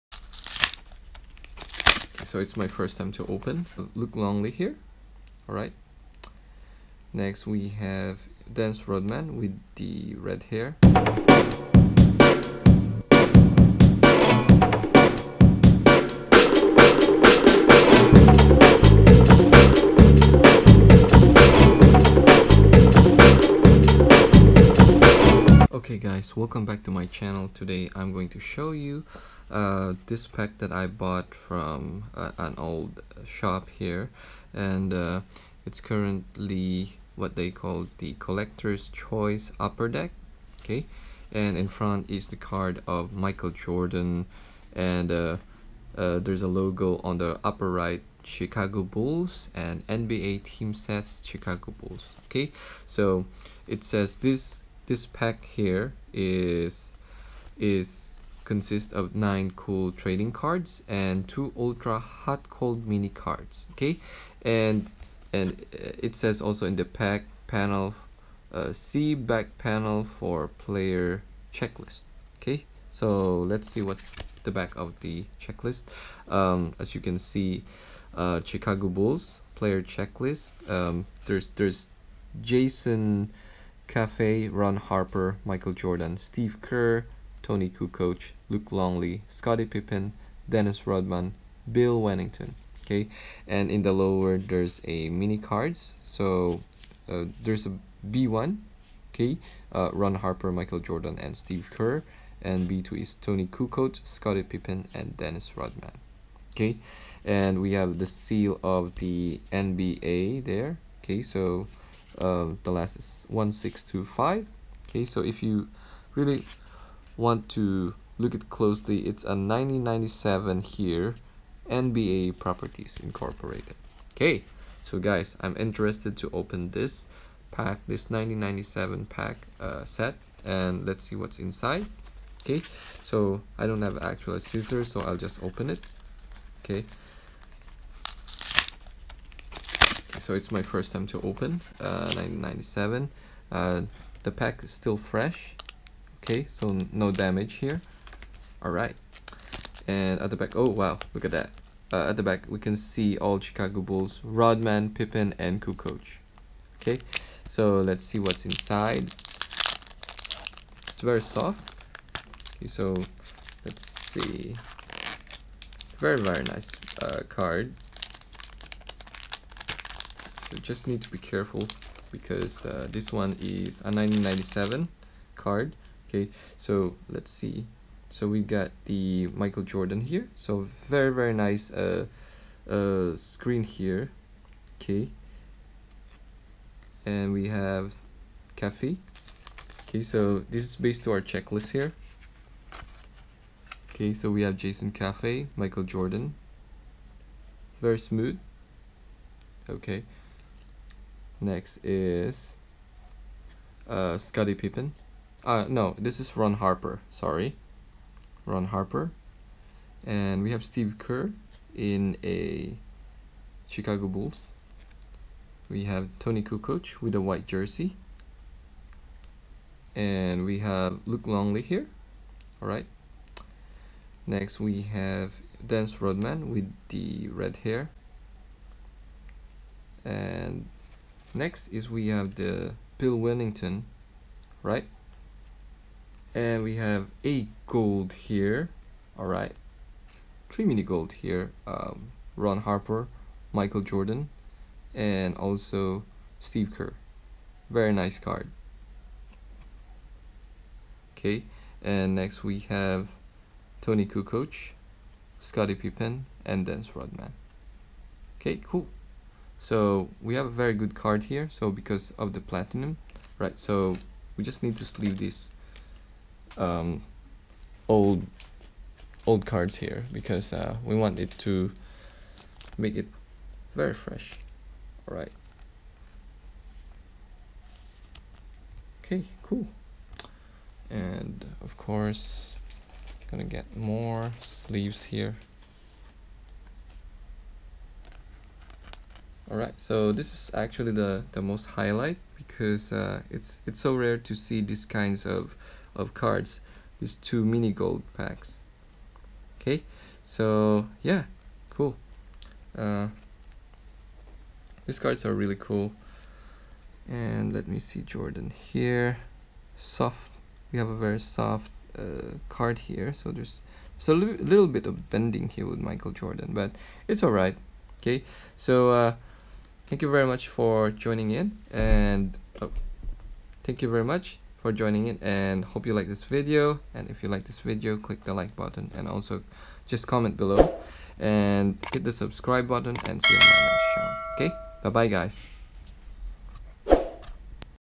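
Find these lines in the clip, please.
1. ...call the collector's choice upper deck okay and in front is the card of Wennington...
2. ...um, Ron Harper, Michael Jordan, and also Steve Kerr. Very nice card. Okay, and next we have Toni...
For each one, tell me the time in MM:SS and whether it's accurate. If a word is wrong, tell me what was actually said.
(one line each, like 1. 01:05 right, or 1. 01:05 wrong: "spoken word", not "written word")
1. 00:37 wrong: "Michael", not "Wennington"
2. 04:01 right.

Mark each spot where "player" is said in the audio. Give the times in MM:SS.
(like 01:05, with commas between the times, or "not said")
01:10, 01:19.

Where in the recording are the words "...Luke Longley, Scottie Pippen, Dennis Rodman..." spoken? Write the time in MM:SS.
01:28.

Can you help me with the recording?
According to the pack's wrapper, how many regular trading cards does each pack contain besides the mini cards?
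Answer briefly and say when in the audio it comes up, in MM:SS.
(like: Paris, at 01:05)
9, at 00:59.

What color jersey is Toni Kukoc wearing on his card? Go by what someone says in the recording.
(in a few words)
White.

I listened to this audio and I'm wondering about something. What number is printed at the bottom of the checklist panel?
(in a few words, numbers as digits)
1625.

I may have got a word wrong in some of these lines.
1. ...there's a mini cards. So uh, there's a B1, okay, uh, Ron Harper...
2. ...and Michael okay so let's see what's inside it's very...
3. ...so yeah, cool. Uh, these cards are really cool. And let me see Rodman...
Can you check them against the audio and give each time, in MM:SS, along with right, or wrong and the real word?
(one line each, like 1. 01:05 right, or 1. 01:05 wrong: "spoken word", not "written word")
1. 01:34 right
2. 02:35 wrong: "Kukoc", not "Michael"
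3. 05:00 wrong: "Jordan", not "Rodman".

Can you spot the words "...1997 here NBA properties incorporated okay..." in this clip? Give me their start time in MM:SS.
01:59.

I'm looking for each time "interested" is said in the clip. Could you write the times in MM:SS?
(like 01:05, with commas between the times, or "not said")
02:05.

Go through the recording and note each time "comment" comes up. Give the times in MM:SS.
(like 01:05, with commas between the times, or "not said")
05:30.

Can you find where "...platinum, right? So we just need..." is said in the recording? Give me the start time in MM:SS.
04:22.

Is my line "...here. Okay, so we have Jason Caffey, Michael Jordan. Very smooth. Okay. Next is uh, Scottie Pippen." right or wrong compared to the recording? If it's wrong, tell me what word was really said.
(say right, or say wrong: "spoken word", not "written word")
right.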